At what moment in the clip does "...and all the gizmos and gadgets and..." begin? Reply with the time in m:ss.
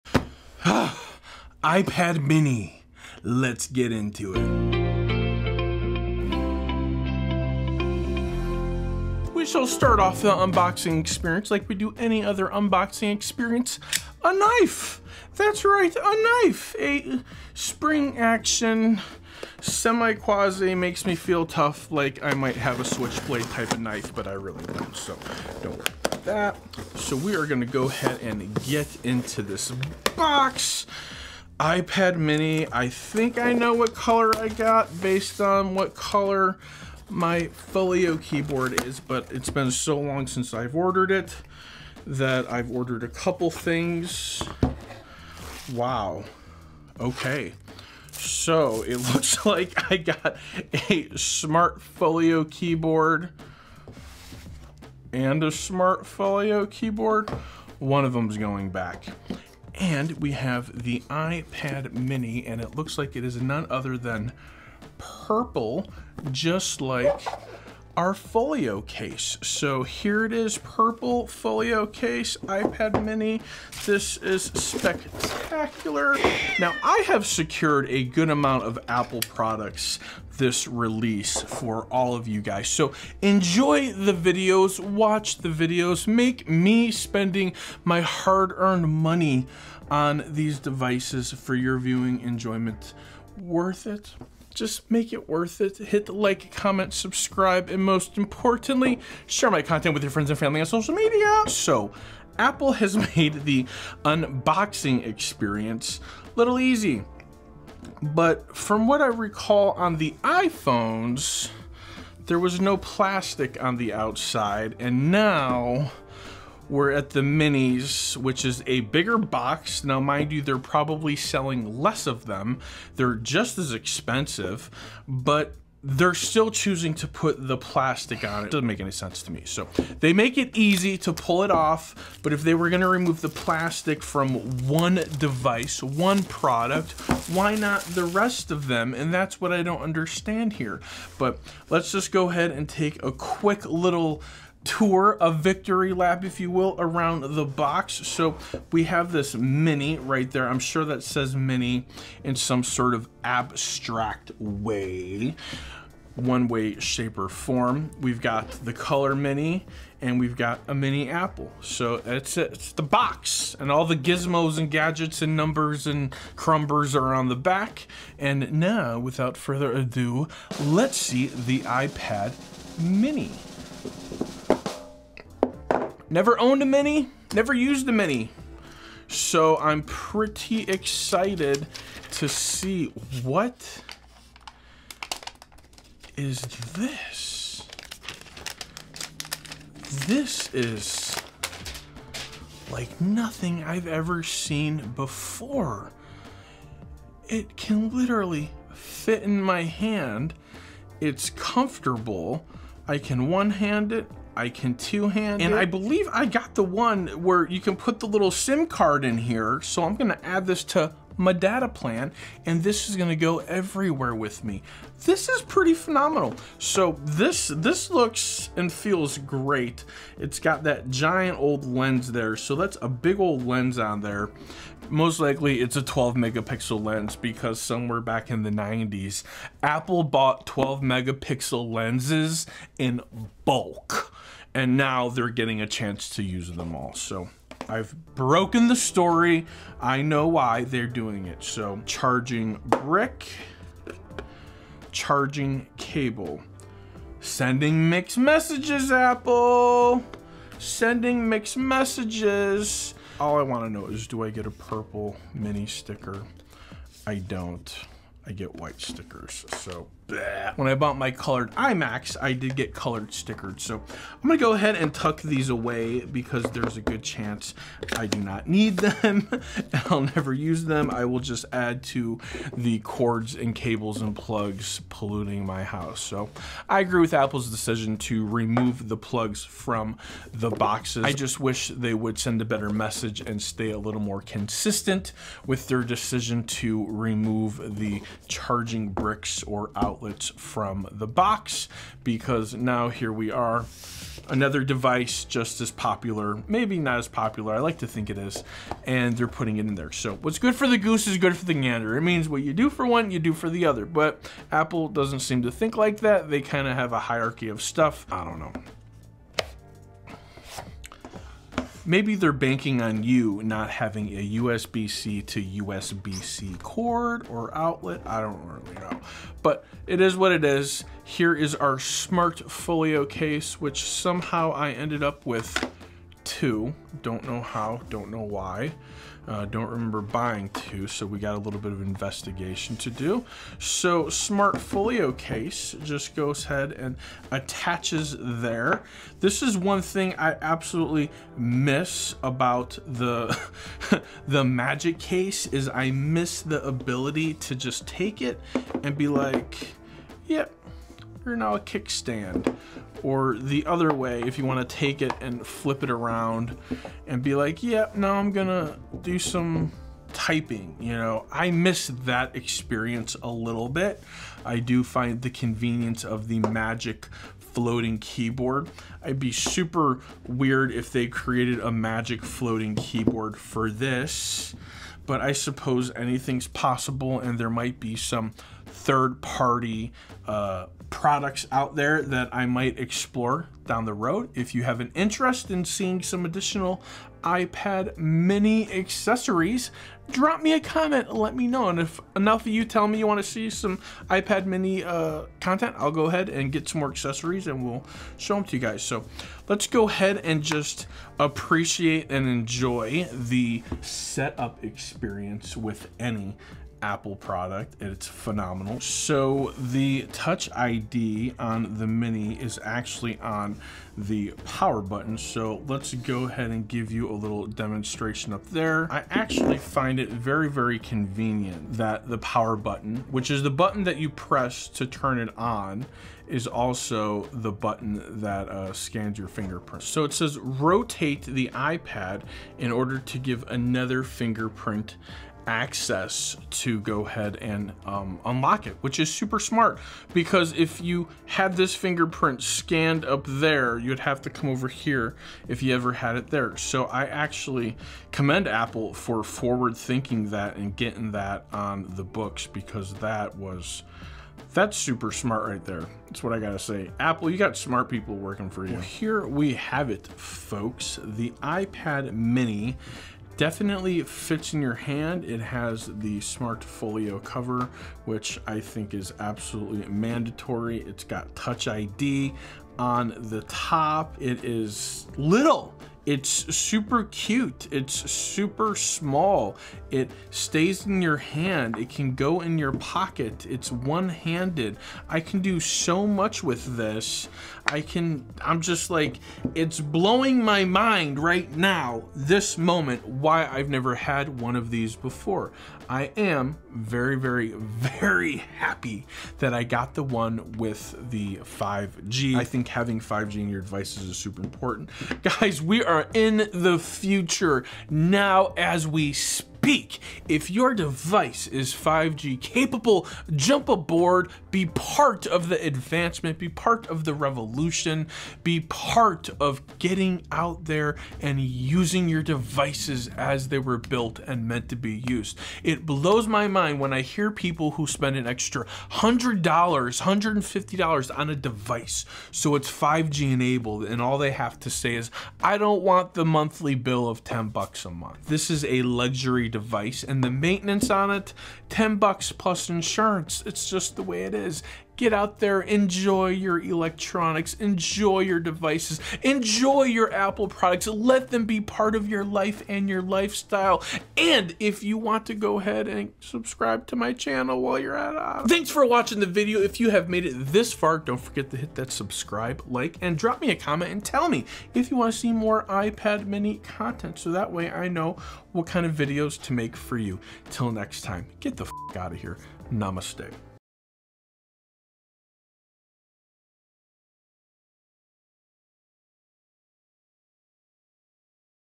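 2:43.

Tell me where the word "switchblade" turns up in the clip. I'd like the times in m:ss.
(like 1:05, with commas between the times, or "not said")
0:22.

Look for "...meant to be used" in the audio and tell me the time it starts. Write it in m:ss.
8:44.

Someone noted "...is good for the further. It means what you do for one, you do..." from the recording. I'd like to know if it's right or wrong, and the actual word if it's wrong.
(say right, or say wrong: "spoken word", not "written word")
wrong: "gander", not "further".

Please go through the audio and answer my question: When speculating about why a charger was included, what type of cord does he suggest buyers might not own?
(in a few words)
USB-C to USB-C.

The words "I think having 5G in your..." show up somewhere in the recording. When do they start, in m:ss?
8:22.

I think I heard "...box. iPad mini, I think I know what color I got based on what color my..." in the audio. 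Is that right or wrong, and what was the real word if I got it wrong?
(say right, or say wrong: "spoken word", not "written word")
right.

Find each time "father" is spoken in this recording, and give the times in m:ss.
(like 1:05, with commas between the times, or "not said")
not said.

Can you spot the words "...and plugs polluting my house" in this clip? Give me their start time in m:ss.
4:34.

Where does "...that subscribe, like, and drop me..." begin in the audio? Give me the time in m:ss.
9:21.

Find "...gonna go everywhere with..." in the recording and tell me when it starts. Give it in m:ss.
3:32.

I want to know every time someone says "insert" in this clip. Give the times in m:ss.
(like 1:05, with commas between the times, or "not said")
not said.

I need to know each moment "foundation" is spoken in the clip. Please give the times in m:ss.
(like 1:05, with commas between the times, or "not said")
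not said.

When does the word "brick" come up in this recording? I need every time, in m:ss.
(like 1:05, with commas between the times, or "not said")
4:02, 4:48.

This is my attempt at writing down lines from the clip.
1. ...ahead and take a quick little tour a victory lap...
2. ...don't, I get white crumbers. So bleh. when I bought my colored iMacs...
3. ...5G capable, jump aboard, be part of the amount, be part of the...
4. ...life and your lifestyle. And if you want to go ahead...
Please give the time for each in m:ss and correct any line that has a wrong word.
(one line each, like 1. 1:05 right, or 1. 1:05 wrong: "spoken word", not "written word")
1. 2:22 right
2. 4:17 wrong: "stickers", not "crumbers"
3. 8:31 wrong: "advancement", not "amount"
4. 9:12 right.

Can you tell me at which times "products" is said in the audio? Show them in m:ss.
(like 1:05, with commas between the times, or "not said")
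1:19, 2:16, 6:20, 6:47, 9:10.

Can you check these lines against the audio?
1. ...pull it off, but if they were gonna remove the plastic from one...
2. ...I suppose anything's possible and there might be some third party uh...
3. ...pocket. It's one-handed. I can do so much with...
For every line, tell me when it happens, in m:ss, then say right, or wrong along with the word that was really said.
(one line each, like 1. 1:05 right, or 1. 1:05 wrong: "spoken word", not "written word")
1. 2:11 right
2. 6:15 right
3. 8:02 right.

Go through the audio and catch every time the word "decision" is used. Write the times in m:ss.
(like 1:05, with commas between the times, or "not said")
4:37, 4:45.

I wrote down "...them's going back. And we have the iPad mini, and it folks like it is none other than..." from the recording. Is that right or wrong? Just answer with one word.
wrong.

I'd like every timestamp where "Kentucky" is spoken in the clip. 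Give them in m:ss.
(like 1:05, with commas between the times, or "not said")
not said.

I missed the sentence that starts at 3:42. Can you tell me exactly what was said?
So that's a big old lens on there.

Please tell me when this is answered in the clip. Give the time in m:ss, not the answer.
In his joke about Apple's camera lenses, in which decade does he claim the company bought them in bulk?
3:48.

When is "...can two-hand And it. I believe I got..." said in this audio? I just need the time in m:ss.
3:24.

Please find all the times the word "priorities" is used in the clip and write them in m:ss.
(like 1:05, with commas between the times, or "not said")
not said.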